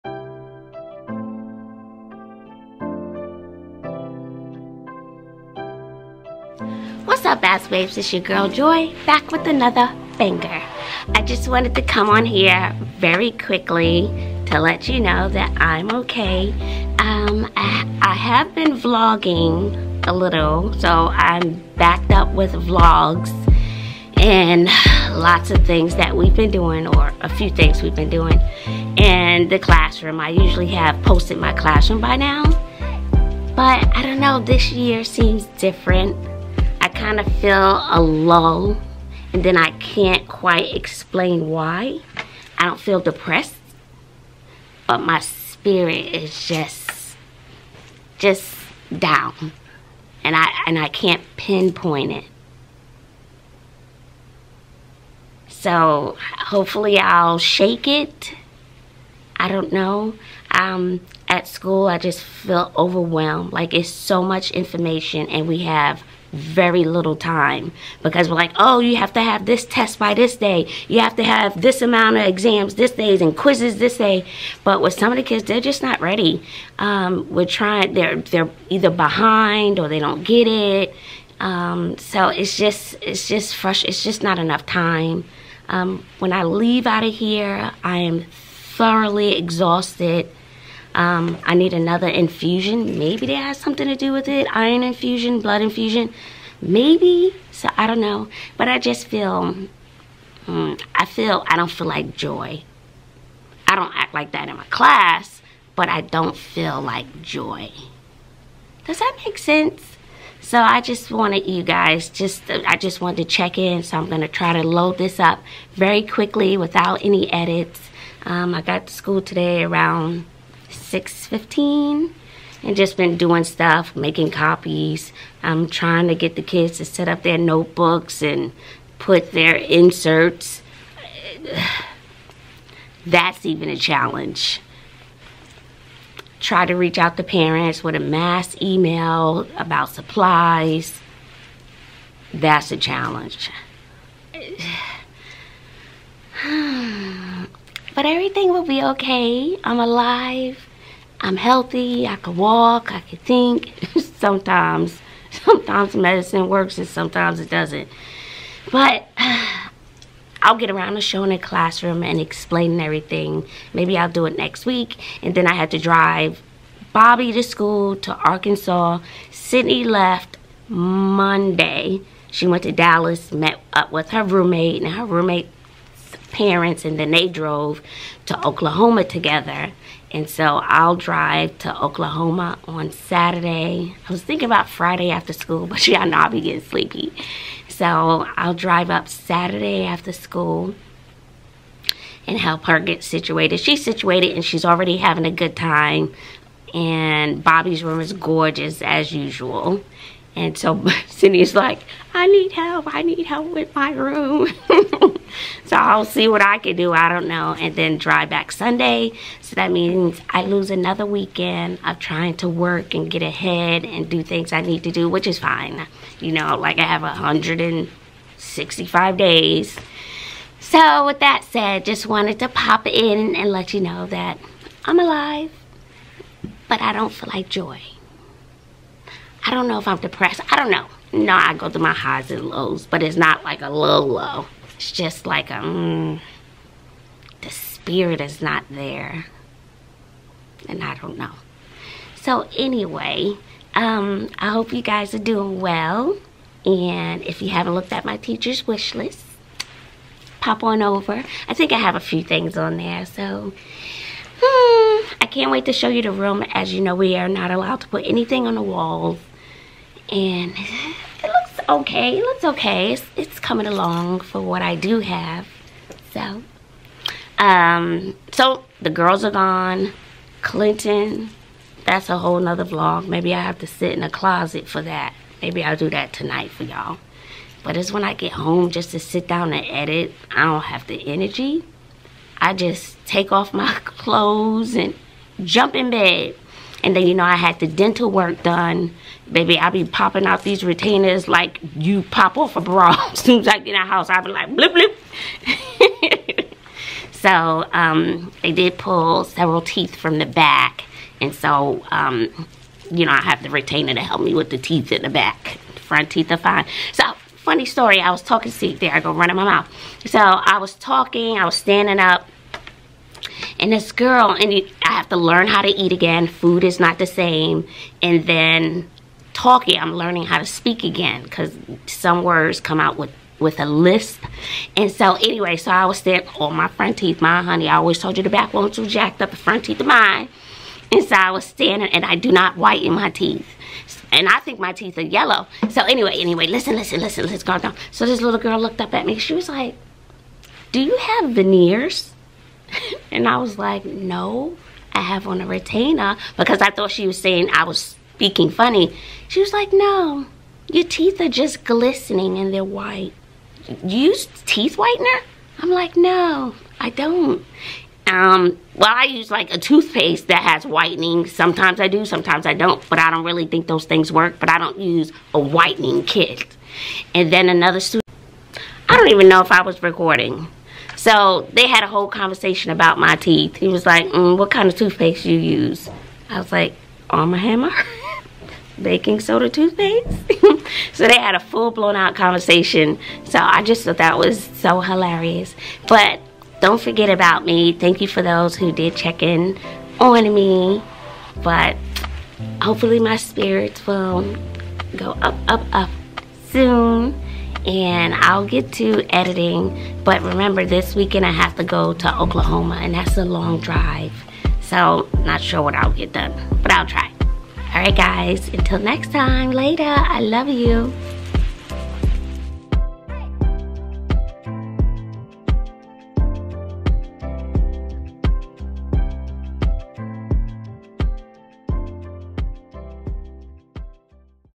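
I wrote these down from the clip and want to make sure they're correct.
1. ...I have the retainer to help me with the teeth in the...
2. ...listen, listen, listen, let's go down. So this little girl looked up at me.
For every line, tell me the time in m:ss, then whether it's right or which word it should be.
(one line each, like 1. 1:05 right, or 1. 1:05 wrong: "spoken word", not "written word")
1. 5:03 right
2. 5:36 right.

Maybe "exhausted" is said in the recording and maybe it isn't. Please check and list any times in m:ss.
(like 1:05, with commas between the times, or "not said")
1:29.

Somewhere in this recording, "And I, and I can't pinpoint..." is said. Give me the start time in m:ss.
0:50.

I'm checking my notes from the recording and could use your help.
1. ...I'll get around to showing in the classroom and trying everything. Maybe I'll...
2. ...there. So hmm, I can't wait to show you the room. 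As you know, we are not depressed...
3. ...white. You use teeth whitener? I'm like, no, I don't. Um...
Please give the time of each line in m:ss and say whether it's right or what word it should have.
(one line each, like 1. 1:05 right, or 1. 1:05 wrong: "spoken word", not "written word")
1. 2:40 wrong: "explaining", not "trying"
2. 4:12 wrong: "allowed", not "depressed"
3. 5:52 right.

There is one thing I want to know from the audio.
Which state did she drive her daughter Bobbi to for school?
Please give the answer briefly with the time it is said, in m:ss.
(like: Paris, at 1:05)
Arkansas, at 2:48.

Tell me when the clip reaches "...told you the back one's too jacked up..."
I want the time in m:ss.
5:27.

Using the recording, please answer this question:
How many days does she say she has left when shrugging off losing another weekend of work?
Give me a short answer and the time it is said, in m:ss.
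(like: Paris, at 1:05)
165, at 3:37.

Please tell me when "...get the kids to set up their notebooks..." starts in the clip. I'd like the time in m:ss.
2:06.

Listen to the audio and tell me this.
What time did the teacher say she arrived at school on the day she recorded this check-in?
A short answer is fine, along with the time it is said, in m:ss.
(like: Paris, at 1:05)
6:15, at 2:00.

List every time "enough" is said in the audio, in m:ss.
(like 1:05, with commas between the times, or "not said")
1:24.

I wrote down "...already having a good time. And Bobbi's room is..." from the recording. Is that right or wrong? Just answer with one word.
right.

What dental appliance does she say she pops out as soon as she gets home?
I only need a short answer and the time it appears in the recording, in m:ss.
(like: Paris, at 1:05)
Retainers, at 4:50.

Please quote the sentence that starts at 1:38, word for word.
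But I just feel, mm, I feel, I don't feel like joy.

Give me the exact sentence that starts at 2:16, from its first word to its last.
Try to reach out to parents with a mass email about supplies.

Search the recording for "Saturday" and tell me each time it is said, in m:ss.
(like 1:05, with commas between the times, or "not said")
3:02, 3:09.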